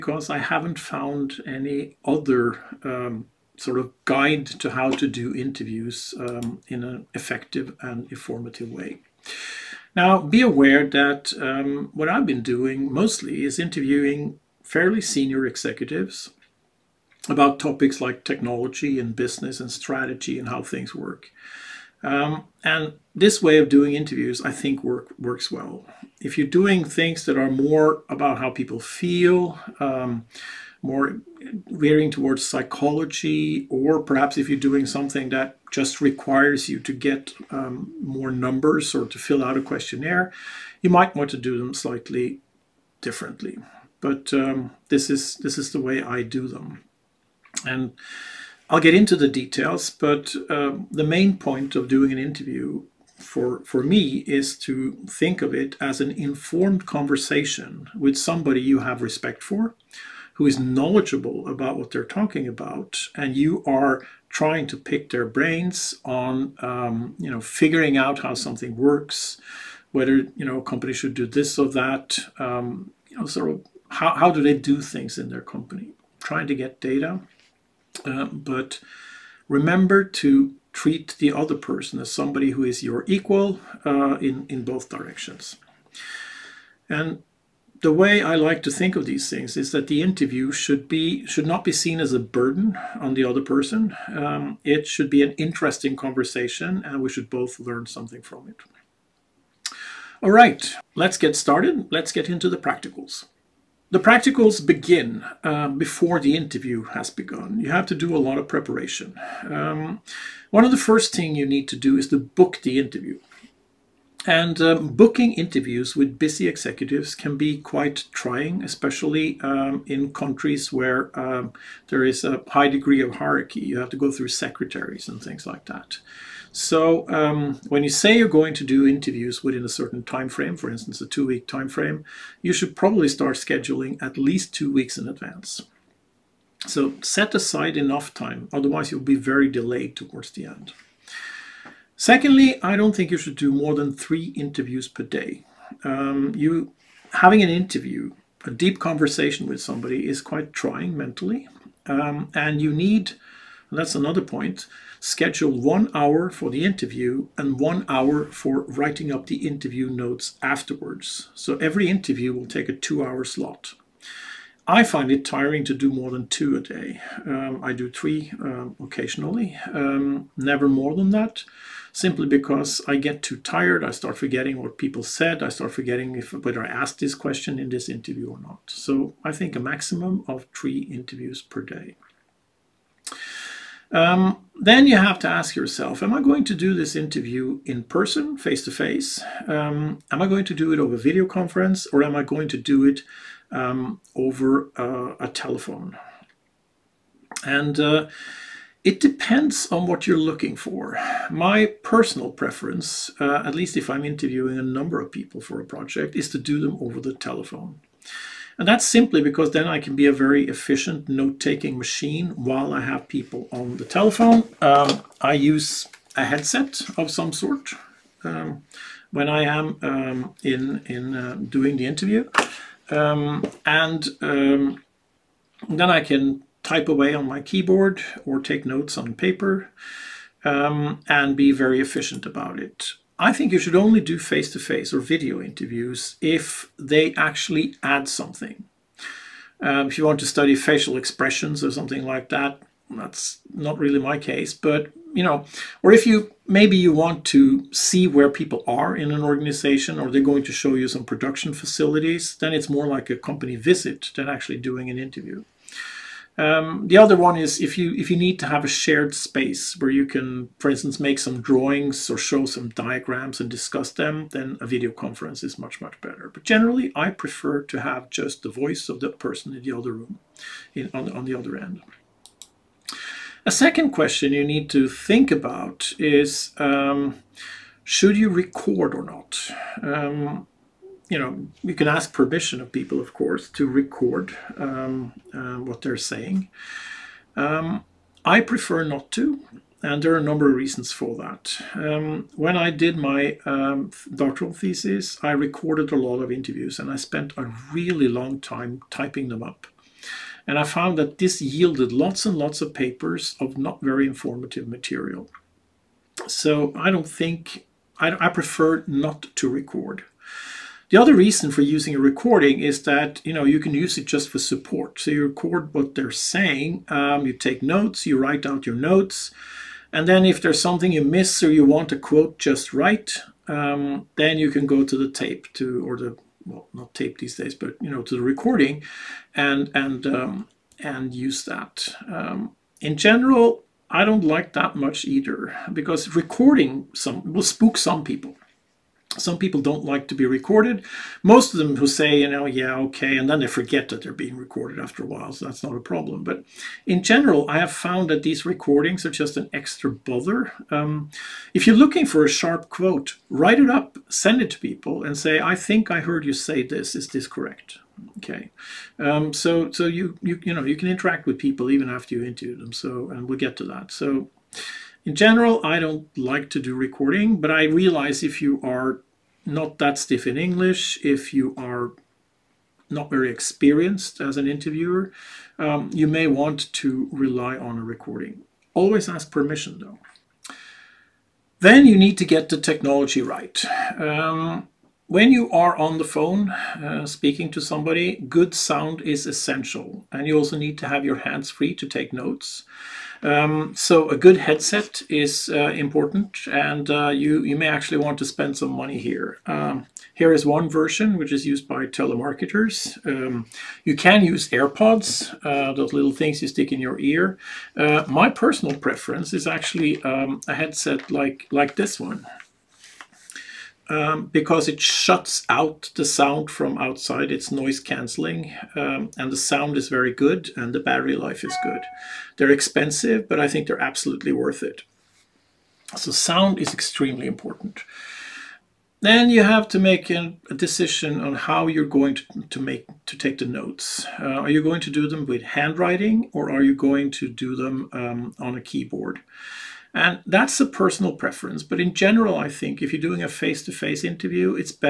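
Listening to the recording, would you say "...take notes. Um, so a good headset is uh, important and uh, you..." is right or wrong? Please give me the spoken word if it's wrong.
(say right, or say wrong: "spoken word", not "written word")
right.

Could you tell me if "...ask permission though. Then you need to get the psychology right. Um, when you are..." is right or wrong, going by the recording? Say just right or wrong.
wrong.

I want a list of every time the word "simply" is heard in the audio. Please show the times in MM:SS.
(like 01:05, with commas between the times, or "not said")
02:51, 03:28.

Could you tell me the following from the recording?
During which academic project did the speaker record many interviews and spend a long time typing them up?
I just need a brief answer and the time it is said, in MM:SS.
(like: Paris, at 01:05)
Doctoral thesis, at 04:54.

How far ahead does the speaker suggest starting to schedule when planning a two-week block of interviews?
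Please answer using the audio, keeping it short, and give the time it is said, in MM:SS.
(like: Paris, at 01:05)
At least two weeks, at 02:14.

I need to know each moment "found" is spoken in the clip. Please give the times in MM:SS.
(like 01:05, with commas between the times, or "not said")
00:00, 05:00, 05:47.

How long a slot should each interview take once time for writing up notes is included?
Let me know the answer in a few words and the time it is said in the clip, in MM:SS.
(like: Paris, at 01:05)
2 hours, at 02:42.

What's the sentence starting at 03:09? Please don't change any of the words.
Um, am I going to do it over video conference or am I going to do it um, over uh, a telephone?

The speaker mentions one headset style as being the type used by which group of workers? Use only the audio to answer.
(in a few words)
Telemarketers.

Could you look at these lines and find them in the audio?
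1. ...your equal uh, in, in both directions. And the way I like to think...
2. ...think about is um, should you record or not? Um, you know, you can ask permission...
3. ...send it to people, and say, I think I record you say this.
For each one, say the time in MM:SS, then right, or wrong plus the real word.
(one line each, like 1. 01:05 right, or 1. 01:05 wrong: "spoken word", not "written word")
1. 01:22 right
2. 04:34 right
3. 05:54 wrong: "heard", not "record".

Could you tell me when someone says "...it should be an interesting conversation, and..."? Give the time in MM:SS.
01:34.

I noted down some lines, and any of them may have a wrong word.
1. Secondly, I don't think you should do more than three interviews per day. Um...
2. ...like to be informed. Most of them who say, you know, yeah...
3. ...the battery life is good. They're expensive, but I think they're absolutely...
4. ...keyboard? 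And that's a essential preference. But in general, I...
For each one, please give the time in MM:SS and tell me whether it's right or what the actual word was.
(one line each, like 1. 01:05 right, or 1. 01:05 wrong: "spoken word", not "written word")
1. 02:21 right
2. 05:39 wrong: "recorded", not "informed"
3. 07:00 right
4. 07:18 wrong: "personal", not "essential".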